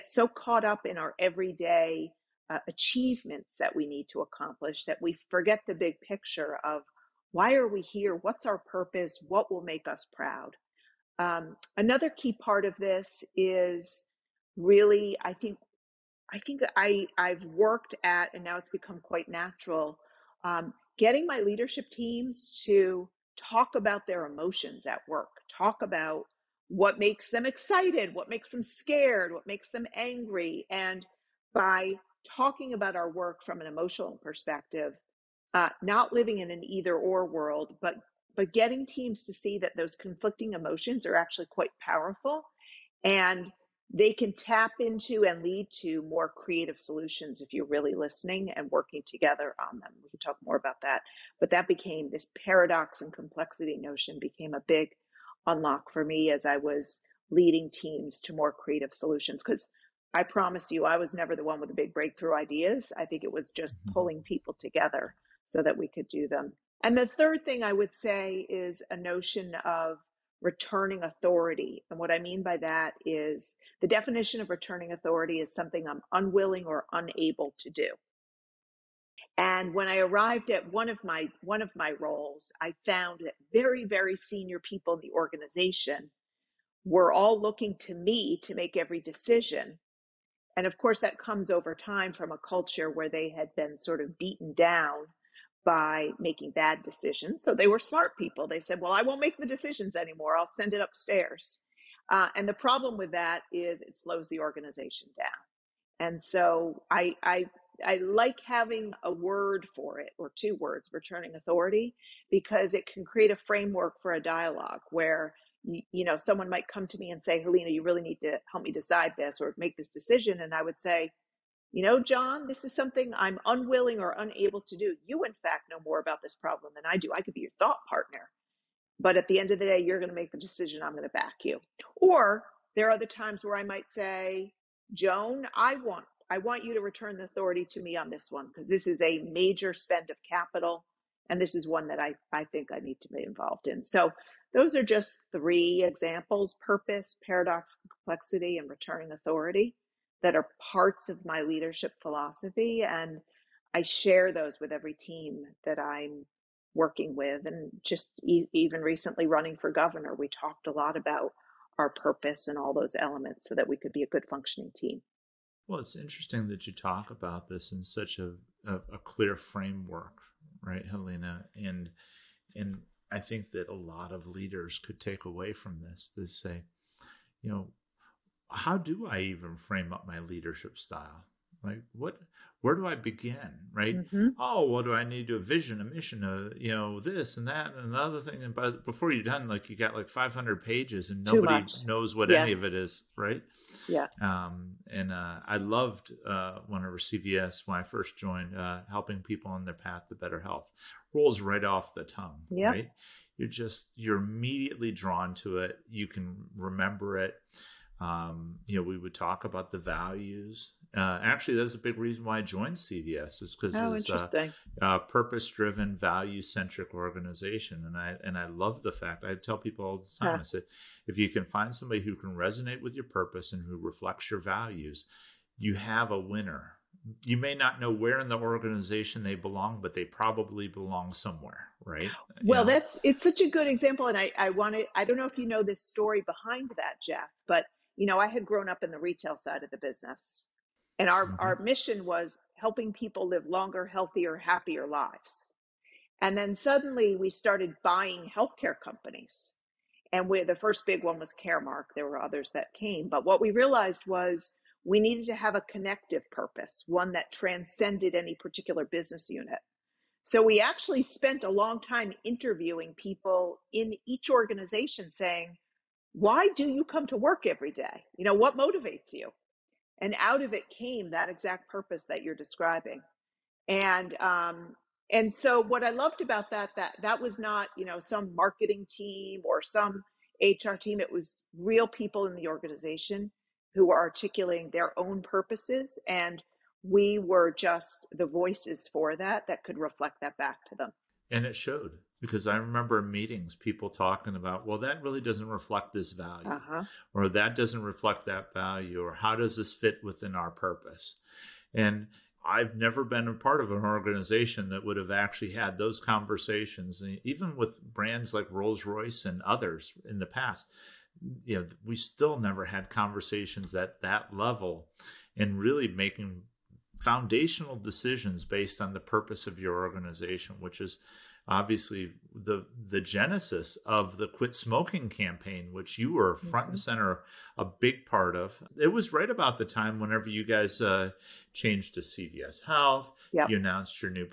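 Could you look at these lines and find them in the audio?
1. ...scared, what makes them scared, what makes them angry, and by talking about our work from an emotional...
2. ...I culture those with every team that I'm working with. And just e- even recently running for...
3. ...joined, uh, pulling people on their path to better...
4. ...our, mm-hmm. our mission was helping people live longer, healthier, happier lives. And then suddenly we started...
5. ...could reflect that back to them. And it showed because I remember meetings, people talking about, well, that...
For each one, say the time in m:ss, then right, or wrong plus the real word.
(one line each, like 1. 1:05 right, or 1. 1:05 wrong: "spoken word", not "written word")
1. 0:27 wrong: "excited", not "scared"
2. 2:33 wrong: "share", not "culture"
3. 3:18 wrong: "helping", not "pulling"
4. 4:01 right
5. 4:49 right.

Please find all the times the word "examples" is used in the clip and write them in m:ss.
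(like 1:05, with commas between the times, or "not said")
2:25, 3:53.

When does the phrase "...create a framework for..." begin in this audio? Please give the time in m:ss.
1:53.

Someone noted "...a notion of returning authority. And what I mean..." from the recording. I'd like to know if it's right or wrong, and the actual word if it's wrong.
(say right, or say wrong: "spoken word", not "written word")
right.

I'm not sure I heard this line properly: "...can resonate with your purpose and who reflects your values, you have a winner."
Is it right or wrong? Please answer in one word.
right.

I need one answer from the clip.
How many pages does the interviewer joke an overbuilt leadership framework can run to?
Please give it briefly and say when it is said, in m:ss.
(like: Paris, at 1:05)
500, at 3:10.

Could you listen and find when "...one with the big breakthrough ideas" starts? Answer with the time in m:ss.
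1:01.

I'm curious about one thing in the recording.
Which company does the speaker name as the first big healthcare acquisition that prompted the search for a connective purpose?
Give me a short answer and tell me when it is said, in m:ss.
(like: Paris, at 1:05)
Caremark, at 4:11.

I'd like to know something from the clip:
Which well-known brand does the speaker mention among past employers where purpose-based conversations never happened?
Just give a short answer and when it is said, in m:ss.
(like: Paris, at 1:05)
Rolls Royce, at 5:08.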